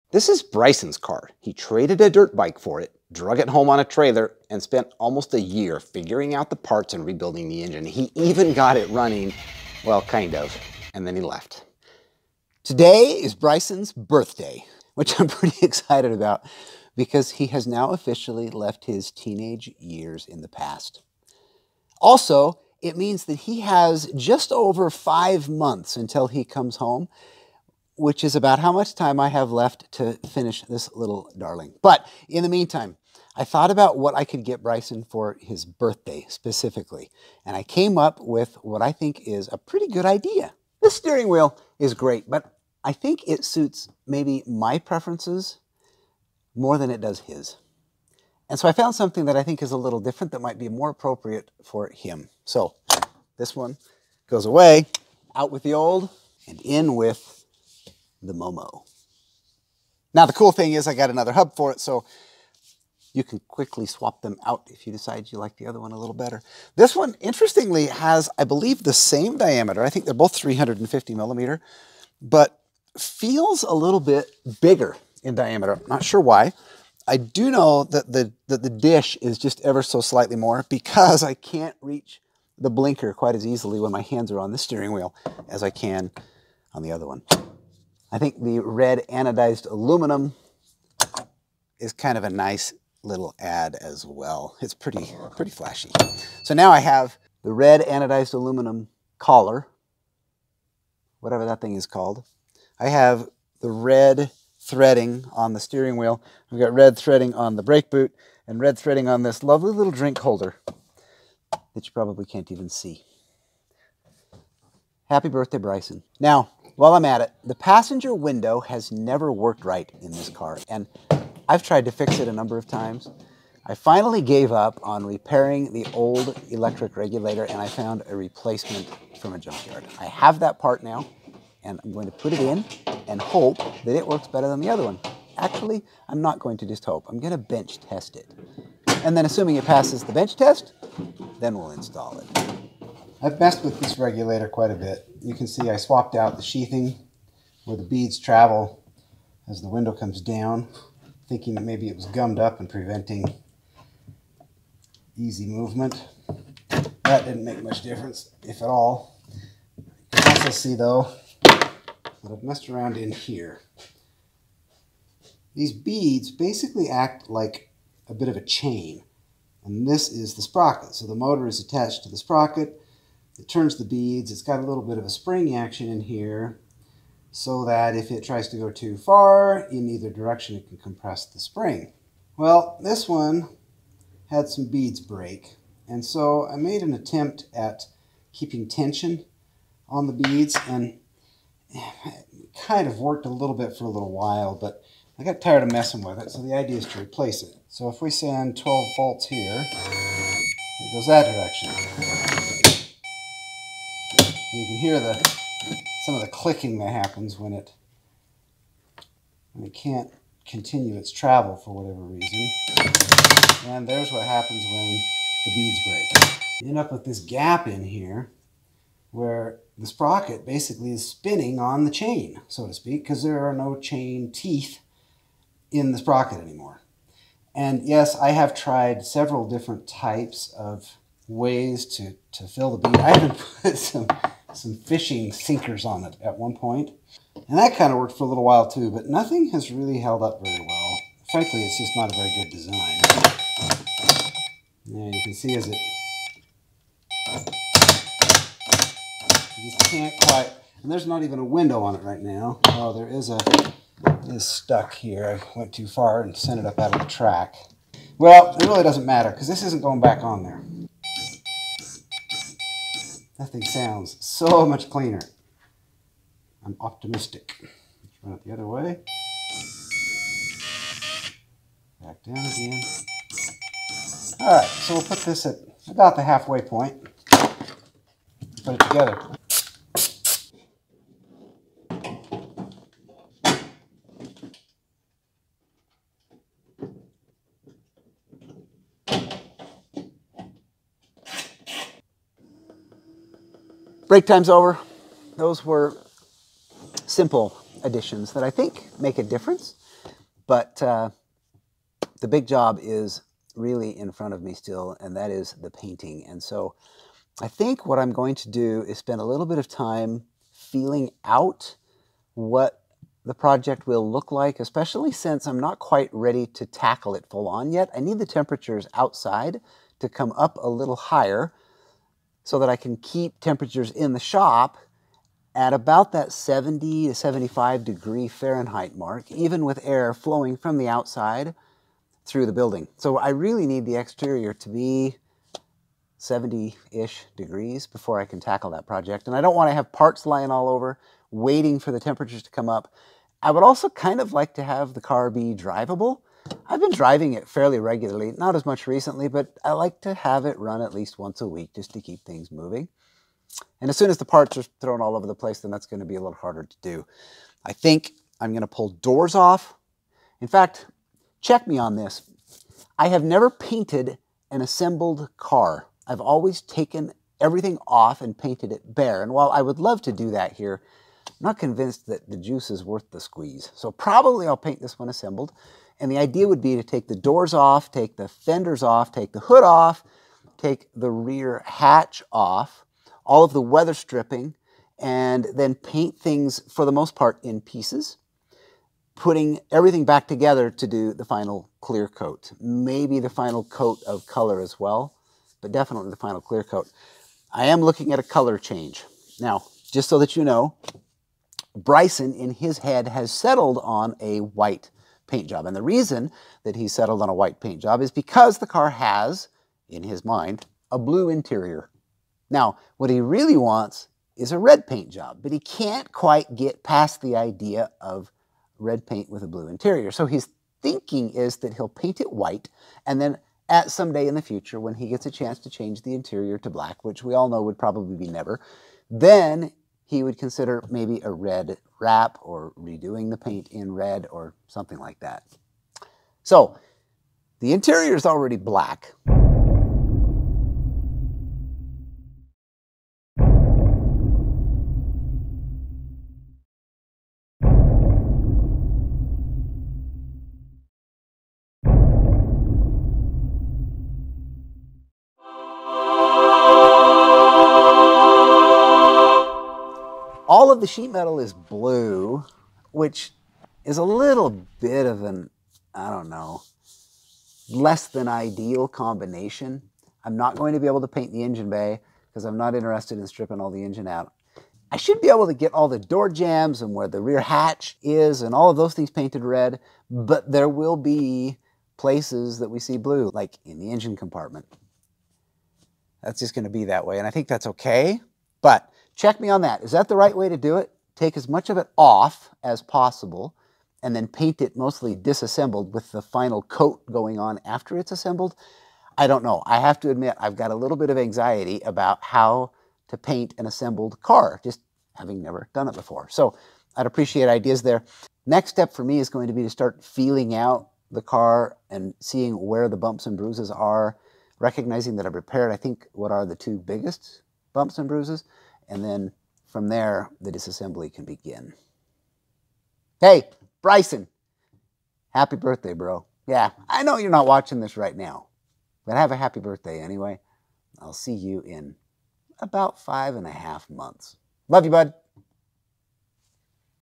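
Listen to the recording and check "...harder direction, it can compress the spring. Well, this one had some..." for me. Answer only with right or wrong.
wrong.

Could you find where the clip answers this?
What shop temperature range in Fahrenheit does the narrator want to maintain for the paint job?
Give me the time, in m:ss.
5:26.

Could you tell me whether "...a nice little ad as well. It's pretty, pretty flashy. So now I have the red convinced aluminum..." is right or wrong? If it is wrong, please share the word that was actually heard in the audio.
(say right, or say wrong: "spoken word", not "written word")
wrong: "anodized", not "convinced".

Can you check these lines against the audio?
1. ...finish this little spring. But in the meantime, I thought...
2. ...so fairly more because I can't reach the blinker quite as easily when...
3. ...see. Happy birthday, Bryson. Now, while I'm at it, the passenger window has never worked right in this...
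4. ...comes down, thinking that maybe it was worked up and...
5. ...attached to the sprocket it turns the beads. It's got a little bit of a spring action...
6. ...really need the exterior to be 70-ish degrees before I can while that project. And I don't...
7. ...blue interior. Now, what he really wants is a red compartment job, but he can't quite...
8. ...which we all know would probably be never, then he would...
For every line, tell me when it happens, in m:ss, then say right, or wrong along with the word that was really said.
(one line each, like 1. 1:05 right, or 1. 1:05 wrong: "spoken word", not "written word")
1. 0:30 wrong: "darling", not "spring"
2. 1:19 wrong: "slightly", not "fairly"
3. 1:52 right
4. 2:29 wrong: "gummed", not "worked"
5. 2:51 right
6. 5:33 wrong: "tackle", not "while"
7. 6:50 wrong: "paint", not "compartment"
8. 7:07 right.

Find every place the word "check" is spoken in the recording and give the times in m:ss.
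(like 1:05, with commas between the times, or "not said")
6:01, 8:09.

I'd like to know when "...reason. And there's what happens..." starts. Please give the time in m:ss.
3:32.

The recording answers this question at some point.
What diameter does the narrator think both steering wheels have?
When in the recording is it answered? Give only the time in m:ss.
1:10.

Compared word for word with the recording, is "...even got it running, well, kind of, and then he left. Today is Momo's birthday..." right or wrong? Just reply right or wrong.
wrong.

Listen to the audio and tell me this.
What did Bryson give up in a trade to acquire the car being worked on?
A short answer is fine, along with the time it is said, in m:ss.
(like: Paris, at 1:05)
A dirt bike, at 0:02.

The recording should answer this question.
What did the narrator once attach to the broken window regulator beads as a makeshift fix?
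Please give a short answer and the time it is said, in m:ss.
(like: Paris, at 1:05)
Fishing sinkers, at 3:54.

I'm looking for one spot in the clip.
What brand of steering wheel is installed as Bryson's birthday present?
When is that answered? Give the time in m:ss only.
0:58.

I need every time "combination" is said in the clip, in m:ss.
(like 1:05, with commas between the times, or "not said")
7:48.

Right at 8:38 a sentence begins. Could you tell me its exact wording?
And then from there, the disassembly can begin.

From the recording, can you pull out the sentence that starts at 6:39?
Now, just so that you know, Bryson, in his head, has settled on a white paint job.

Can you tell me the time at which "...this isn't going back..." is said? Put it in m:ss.
4:19.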